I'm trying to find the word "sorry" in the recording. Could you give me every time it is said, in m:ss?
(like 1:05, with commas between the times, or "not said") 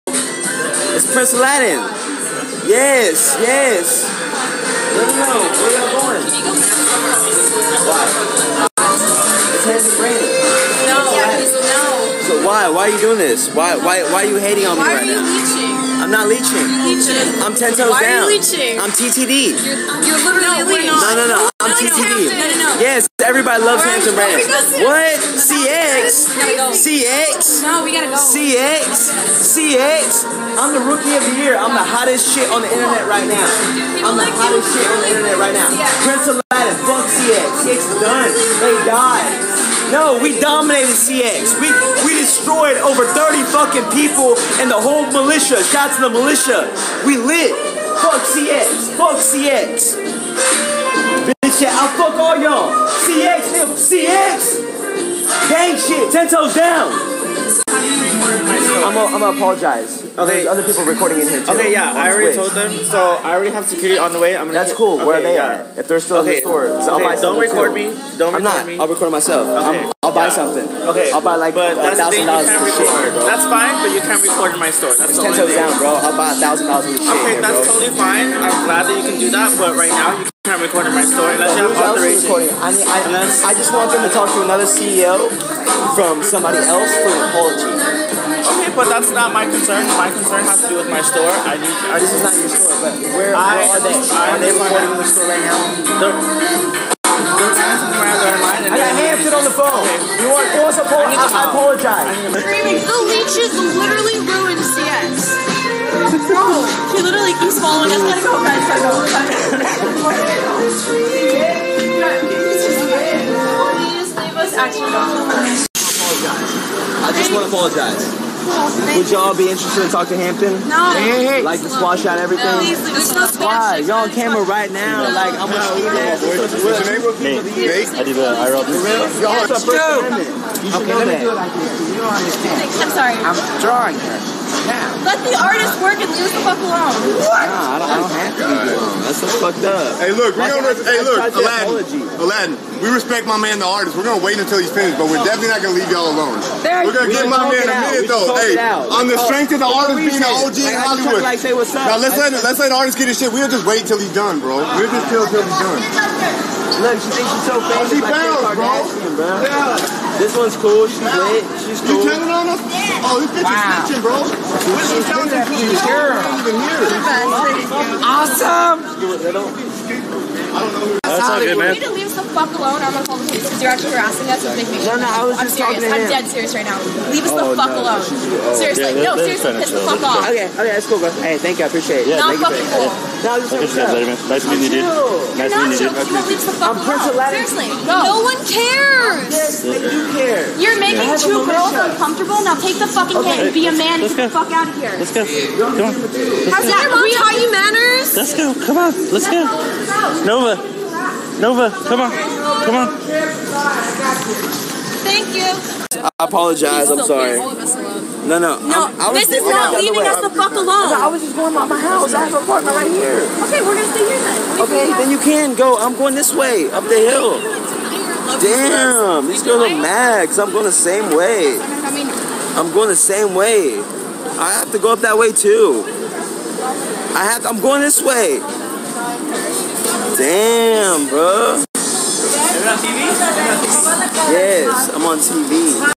2:12, 3:27.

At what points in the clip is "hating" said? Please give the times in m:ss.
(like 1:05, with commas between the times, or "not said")
0:14.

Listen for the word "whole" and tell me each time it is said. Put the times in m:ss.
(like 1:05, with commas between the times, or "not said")
0:44.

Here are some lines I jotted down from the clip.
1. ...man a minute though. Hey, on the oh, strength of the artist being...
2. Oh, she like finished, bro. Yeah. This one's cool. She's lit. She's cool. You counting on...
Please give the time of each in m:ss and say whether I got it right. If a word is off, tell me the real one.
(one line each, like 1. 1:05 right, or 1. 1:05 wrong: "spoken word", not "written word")
1. 2:27 right
2. 2:37 wrong: "bounced", not "finished".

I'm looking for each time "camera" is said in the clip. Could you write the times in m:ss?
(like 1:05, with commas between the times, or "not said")
2:04.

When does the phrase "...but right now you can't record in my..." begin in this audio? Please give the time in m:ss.
1:19.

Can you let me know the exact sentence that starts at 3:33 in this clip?
Okay, we're gonna stay here then.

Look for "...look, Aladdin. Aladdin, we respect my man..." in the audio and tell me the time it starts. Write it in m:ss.
2:21.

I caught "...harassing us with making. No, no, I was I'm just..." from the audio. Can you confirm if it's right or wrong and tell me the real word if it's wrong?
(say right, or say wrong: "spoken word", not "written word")
right.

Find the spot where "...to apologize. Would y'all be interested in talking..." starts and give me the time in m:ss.
1:57.